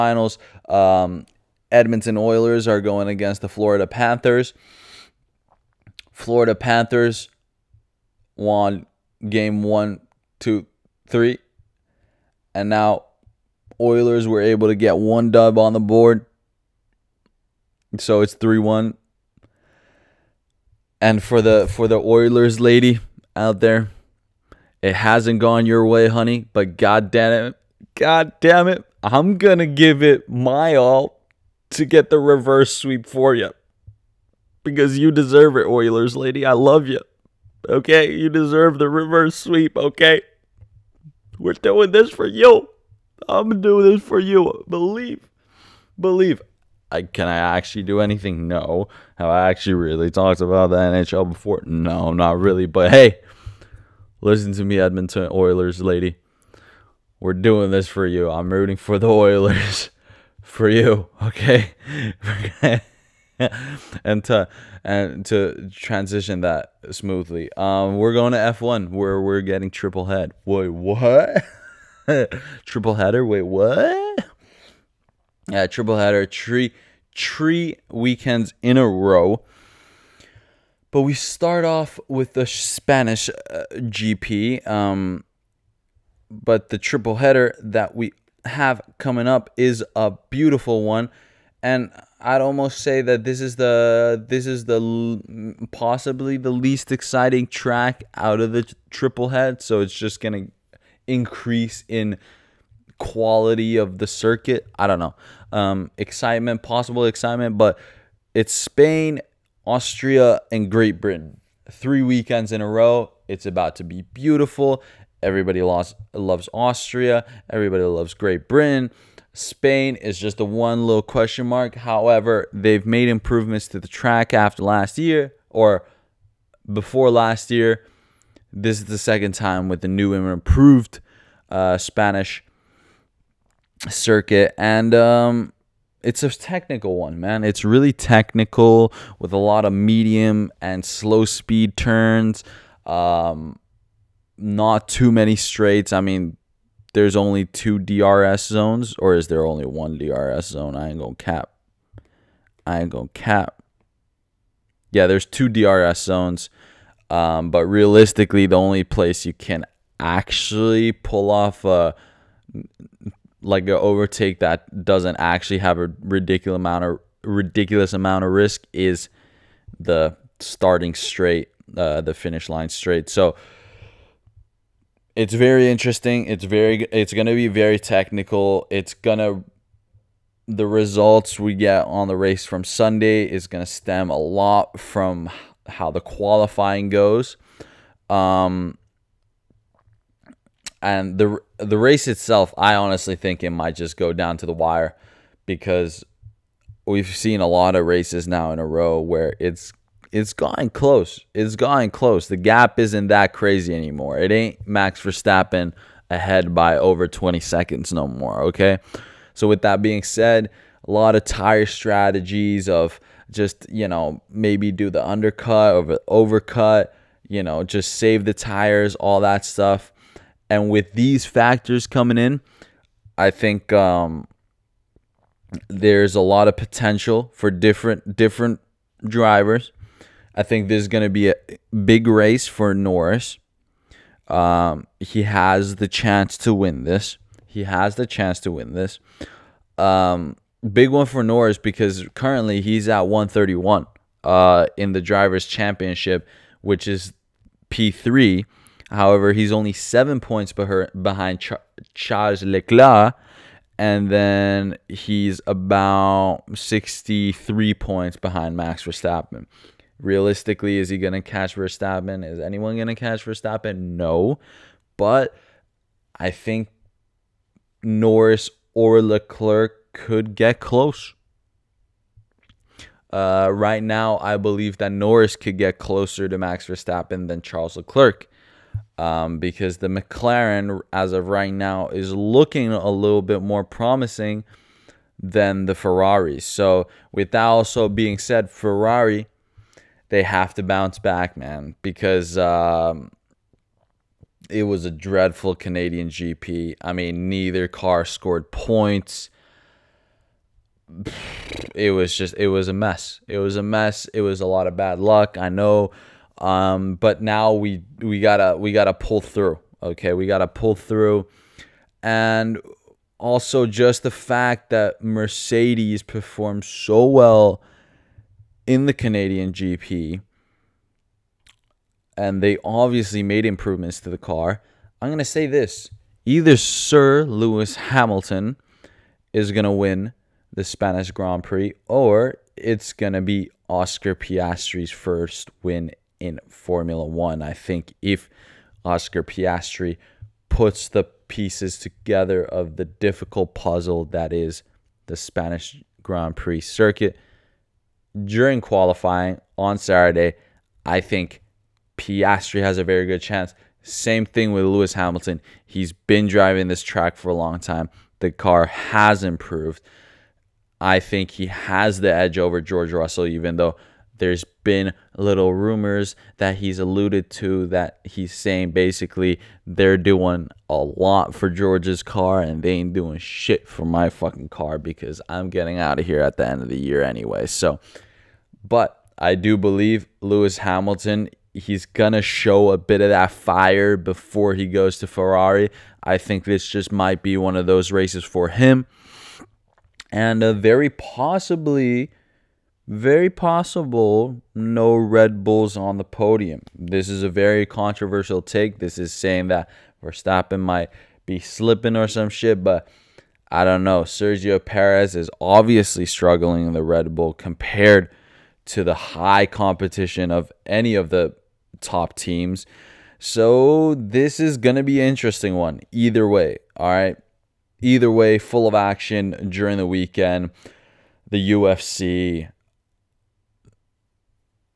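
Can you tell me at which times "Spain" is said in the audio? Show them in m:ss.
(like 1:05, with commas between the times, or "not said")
1:48, 1:59.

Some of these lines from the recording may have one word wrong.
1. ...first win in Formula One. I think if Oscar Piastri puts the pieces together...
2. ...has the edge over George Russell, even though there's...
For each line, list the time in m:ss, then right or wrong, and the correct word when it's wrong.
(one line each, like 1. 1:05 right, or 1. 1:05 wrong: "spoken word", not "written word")
1. 5:34 right
2. 6:01 right.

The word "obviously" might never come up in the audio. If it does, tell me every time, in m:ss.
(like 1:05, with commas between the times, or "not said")
5:22, 6:45.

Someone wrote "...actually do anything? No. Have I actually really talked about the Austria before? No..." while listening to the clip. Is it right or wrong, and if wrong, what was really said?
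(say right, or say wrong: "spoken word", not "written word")
wrong: "NHL", not "Austria".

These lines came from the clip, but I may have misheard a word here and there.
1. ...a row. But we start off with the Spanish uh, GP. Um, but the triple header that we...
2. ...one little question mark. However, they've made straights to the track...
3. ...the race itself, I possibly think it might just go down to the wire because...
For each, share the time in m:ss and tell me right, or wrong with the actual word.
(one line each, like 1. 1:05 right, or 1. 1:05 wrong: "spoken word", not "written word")
1. 1:18 right
2. 2:00 wrong: "improvements", not "straights"
3. 3:11 wrong: "honestly", not "possibly".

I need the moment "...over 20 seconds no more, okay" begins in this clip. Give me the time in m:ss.
3:26.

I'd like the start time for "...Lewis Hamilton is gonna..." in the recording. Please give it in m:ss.
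5:27.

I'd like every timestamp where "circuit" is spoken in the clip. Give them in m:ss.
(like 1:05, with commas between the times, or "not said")
1:44, 2:13, 5:46.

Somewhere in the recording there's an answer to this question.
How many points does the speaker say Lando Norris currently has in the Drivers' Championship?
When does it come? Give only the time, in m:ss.
4:03.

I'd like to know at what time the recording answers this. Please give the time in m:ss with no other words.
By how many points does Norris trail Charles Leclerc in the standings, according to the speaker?
4:09.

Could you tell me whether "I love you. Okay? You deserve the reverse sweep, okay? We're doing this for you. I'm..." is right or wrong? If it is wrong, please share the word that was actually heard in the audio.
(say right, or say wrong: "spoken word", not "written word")
right.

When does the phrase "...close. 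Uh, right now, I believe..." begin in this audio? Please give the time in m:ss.
4:30.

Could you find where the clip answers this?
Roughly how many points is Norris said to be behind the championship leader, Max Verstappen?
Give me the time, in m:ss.
4:16.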